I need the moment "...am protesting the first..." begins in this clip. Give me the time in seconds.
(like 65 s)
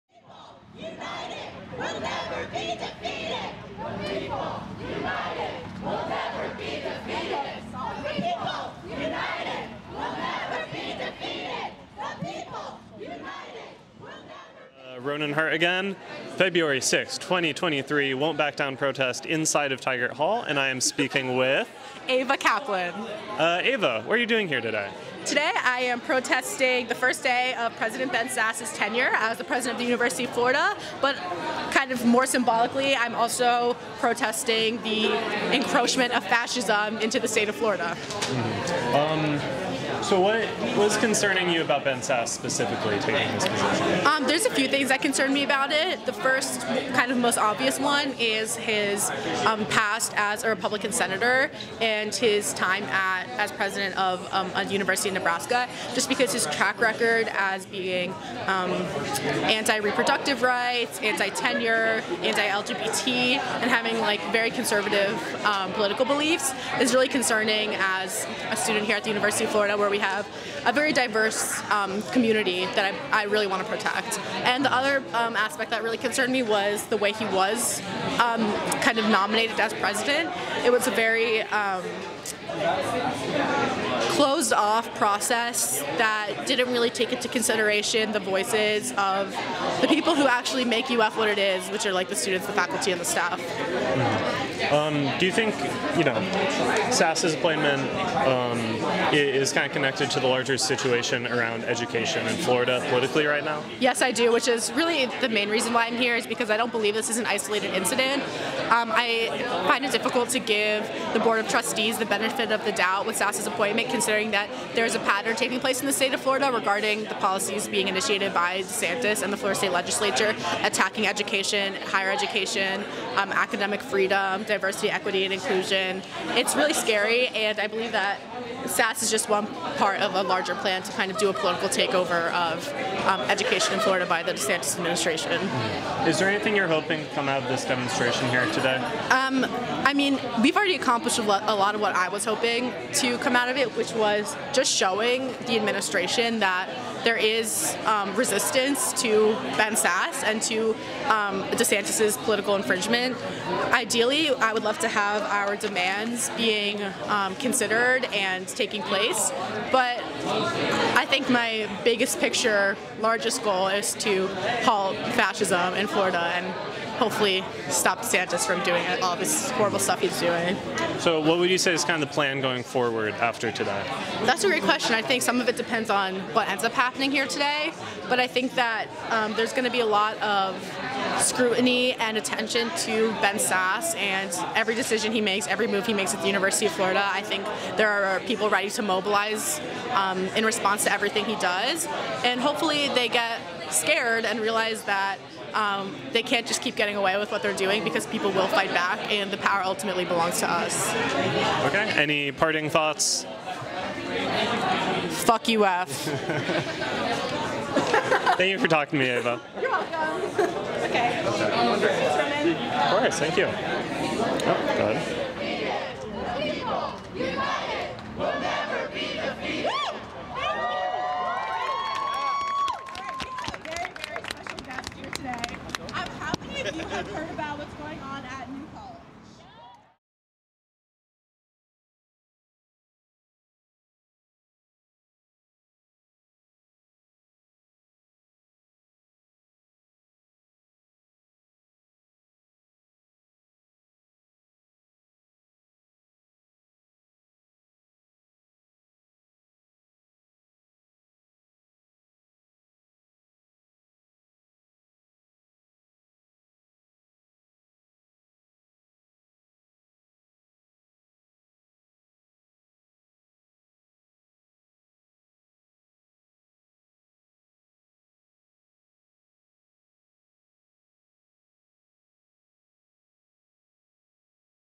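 25 s.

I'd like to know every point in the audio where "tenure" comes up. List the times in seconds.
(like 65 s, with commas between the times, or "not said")
28 s, 60 s.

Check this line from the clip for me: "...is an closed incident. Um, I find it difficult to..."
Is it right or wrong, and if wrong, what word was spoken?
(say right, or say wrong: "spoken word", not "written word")
wrong: "isolated", not "closed".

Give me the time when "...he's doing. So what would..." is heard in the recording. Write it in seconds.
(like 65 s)
170 s.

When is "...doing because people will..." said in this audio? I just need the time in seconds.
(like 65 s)
197 s.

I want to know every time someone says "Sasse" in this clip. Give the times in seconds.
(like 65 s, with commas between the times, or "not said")
28 s, 41 s, 96 s, 113 s, 128 s, 149 s, 183 s.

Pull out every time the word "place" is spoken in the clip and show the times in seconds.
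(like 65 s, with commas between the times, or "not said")
115 s, 158 s.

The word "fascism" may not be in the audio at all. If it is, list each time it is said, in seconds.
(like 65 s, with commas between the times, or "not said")
36 s, 165 s.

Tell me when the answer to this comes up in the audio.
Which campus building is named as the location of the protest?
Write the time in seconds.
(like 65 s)
19 s.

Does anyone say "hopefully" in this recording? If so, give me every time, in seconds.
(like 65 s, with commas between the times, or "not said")
167 s, 192 s.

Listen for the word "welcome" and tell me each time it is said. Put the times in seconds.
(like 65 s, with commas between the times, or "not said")
209 s.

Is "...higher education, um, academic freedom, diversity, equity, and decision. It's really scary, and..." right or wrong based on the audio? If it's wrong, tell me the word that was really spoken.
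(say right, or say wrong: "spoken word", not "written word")
wrong: "inclusion", not "decision".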